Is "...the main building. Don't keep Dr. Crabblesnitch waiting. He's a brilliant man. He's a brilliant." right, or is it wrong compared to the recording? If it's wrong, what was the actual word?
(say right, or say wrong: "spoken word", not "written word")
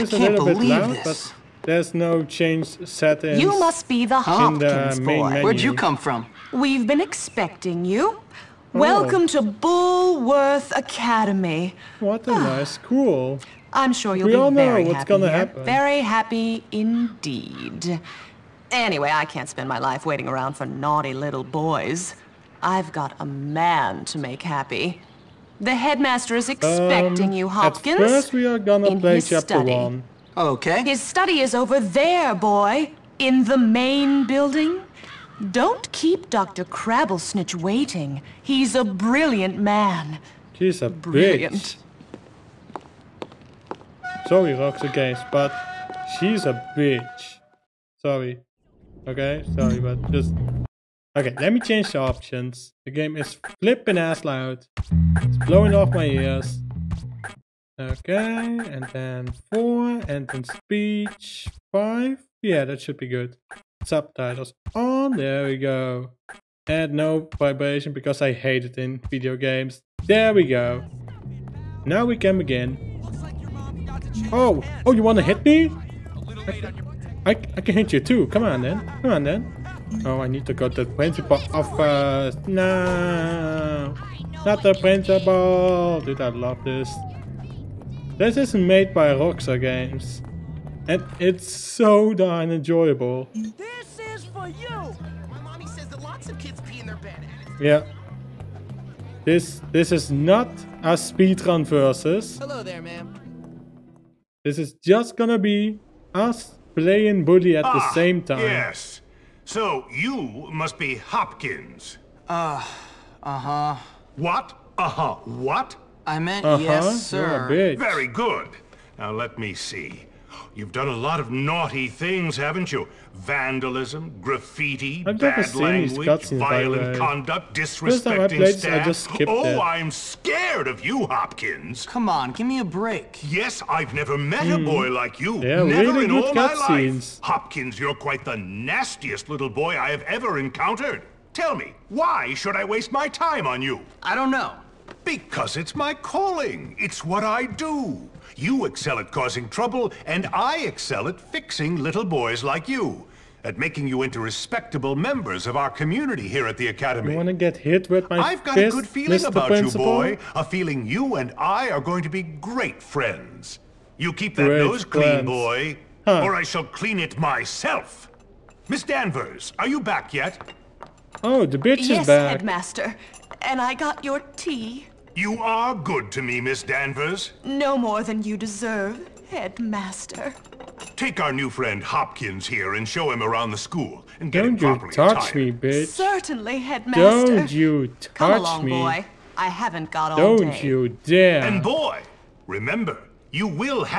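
right.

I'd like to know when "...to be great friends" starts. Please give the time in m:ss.
2:42.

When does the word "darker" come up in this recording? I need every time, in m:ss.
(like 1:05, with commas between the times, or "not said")
not said.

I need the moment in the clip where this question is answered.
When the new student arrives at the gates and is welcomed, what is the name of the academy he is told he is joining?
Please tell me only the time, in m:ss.
0:09.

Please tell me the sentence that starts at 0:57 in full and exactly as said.
Okay, and then 4, and then speech 5.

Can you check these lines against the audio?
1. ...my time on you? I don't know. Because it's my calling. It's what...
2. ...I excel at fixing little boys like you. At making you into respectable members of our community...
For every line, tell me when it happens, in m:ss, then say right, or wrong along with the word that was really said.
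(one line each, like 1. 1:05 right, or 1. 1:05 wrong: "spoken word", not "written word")
1. 2:22 right
2. 2:30 right.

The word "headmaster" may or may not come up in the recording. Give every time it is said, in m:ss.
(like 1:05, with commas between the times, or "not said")
0:25, 2:52, 2:59, 3:06.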